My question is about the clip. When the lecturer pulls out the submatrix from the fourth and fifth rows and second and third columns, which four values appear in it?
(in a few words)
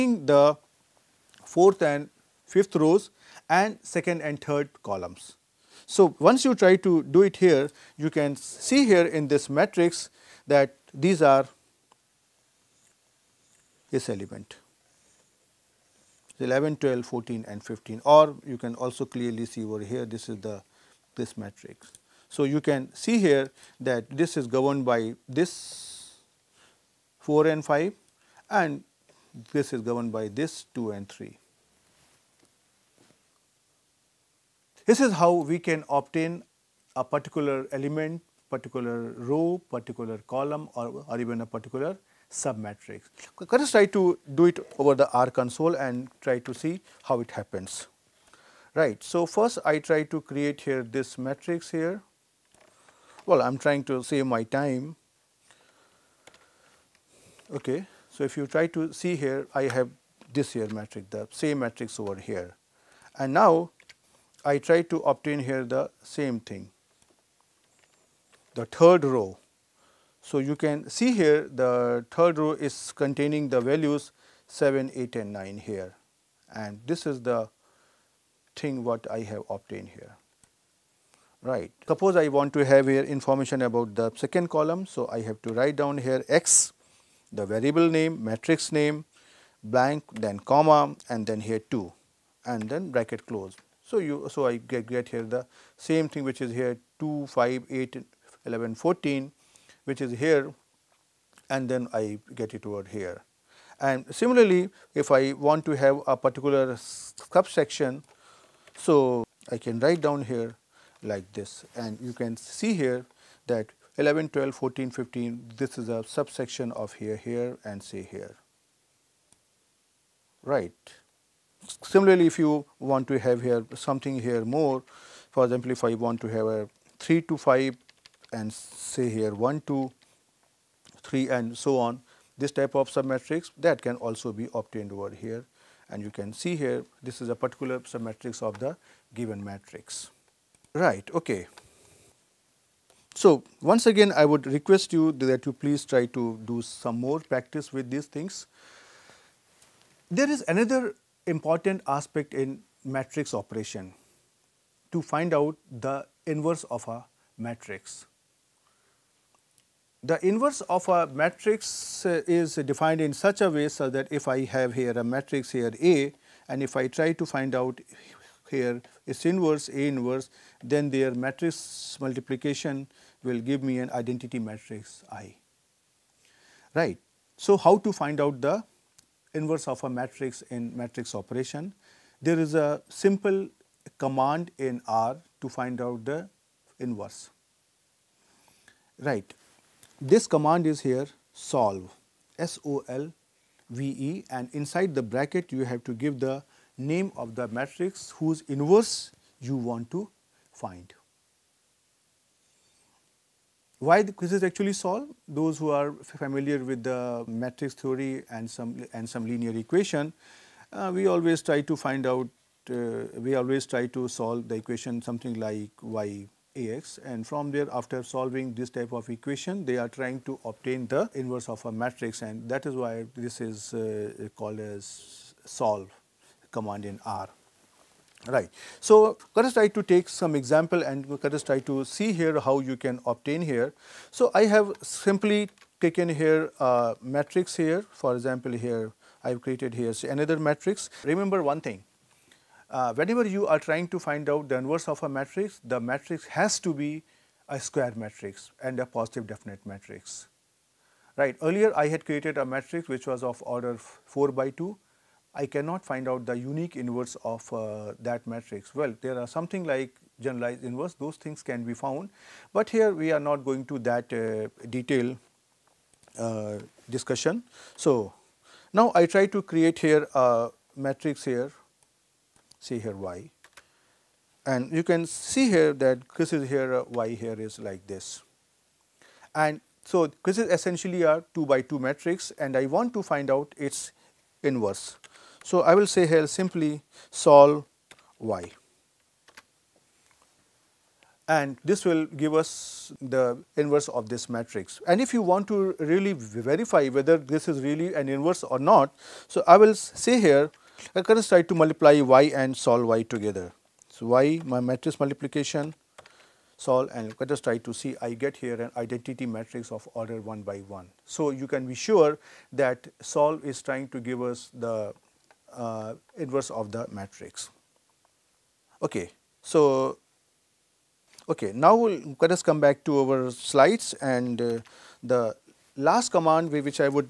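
11, 12, 14, 15.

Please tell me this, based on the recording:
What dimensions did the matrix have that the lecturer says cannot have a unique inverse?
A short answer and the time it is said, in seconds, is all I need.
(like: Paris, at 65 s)
4 by 2, at 253 s.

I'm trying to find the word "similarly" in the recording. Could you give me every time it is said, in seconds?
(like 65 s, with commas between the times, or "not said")
104 s, 121 s.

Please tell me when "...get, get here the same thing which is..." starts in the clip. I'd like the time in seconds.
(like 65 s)
94 s.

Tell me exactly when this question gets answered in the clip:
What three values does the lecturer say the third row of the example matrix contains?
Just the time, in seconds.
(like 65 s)
74 s.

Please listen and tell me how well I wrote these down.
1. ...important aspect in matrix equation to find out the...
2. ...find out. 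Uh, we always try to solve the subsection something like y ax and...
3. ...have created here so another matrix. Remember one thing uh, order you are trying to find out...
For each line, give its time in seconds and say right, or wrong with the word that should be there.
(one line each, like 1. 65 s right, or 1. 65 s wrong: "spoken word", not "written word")
1. 151 s wrong: "operation", not "equation"
2. 211 s wrong: "equation", not "subsection"
3. 239 s wrong: "whenever", not "order".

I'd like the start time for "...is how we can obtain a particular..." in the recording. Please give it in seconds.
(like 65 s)
35 s.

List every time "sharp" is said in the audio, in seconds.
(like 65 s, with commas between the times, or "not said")
not said.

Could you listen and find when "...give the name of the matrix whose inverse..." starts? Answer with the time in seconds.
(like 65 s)
195 s.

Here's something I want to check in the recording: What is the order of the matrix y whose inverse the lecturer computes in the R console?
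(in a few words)
2 by 2.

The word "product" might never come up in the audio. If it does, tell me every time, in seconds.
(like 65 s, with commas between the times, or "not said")
not said.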